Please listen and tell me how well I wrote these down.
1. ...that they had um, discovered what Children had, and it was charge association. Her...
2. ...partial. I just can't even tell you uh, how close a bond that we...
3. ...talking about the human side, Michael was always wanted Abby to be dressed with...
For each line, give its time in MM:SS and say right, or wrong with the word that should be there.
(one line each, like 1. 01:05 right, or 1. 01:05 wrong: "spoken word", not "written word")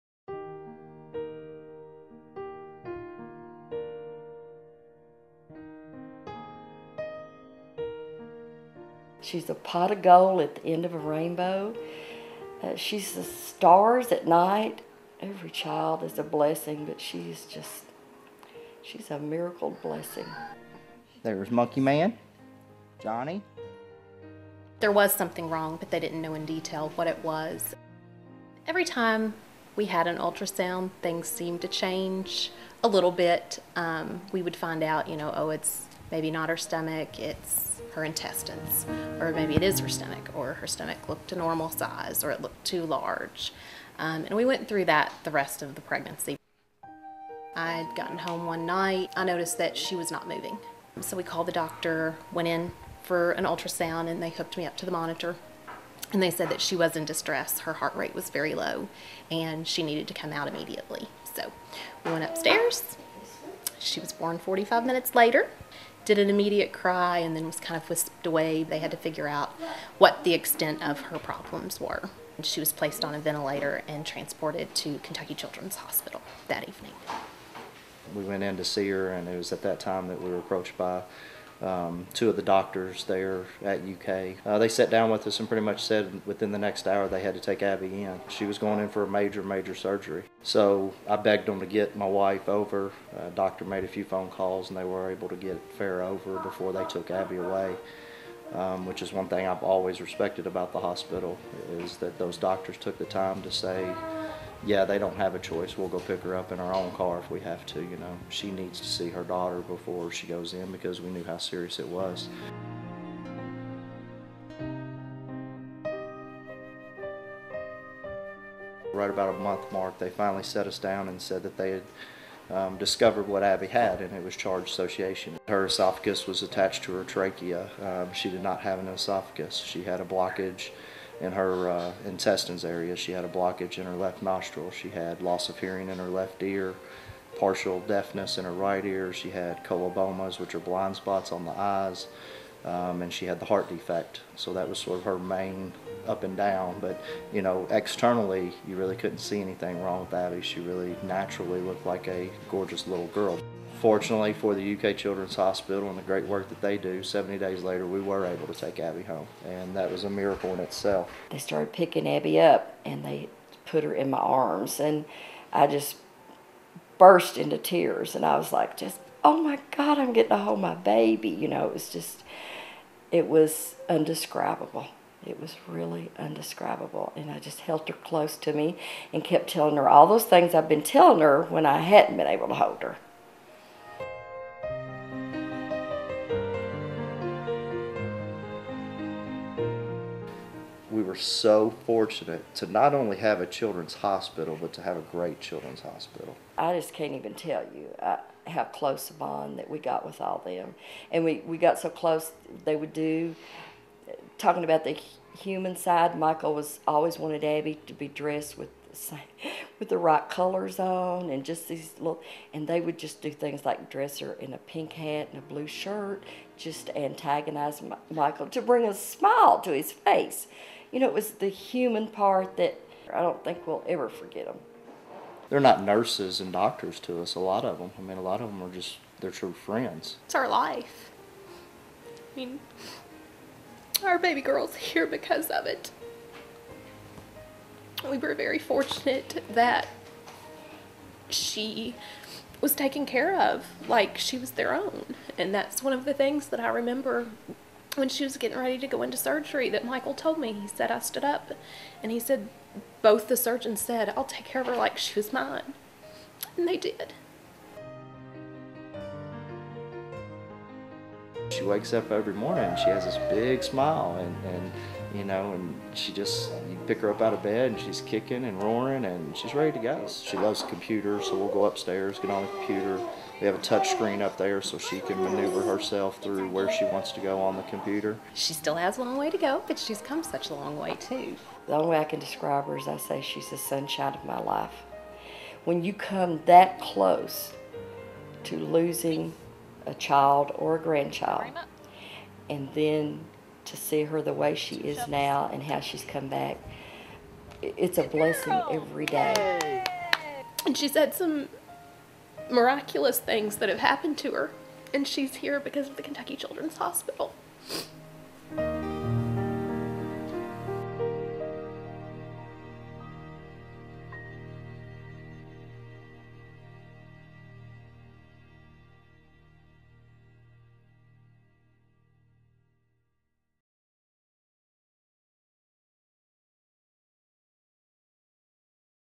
1. 02:01 wrong: "Abby", not "Children"
2. 03:15 wrong: "hospital", not "partial"
3. 03:24 right.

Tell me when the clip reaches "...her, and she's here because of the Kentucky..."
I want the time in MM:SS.
05:04.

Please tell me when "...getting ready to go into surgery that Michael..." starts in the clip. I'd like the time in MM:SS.
04:08.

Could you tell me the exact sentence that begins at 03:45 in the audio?
They're not nurses and doctors to us, a lot of them.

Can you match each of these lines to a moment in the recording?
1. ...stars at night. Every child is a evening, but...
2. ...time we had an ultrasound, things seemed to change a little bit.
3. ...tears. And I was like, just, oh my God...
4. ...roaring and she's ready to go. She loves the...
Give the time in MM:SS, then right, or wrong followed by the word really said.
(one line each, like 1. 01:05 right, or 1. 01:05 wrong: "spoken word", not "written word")
1. 00:13 wrong: "blessing", not "evening"
2. 00:28 right
3. 02:47 right
4. 04:28 right.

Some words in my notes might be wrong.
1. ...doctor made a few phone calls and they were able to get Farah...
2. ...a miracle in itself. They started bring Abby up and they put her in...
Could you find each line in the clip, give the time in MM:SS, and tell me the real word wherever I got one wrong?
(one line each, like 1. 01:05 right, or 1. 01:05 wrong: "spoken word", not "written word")
1. 01:33 right
2. 02:40 wrong: "picking", not "bring".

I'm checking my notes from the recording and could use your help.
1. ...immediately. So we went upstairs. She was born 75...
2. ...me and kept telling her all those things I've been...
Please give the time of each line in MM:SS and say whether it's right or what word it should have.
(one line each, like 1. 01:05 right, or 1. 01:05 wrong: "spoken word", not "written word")
1. 01:00 wrong: "45", not "75"
2. 02:58 right.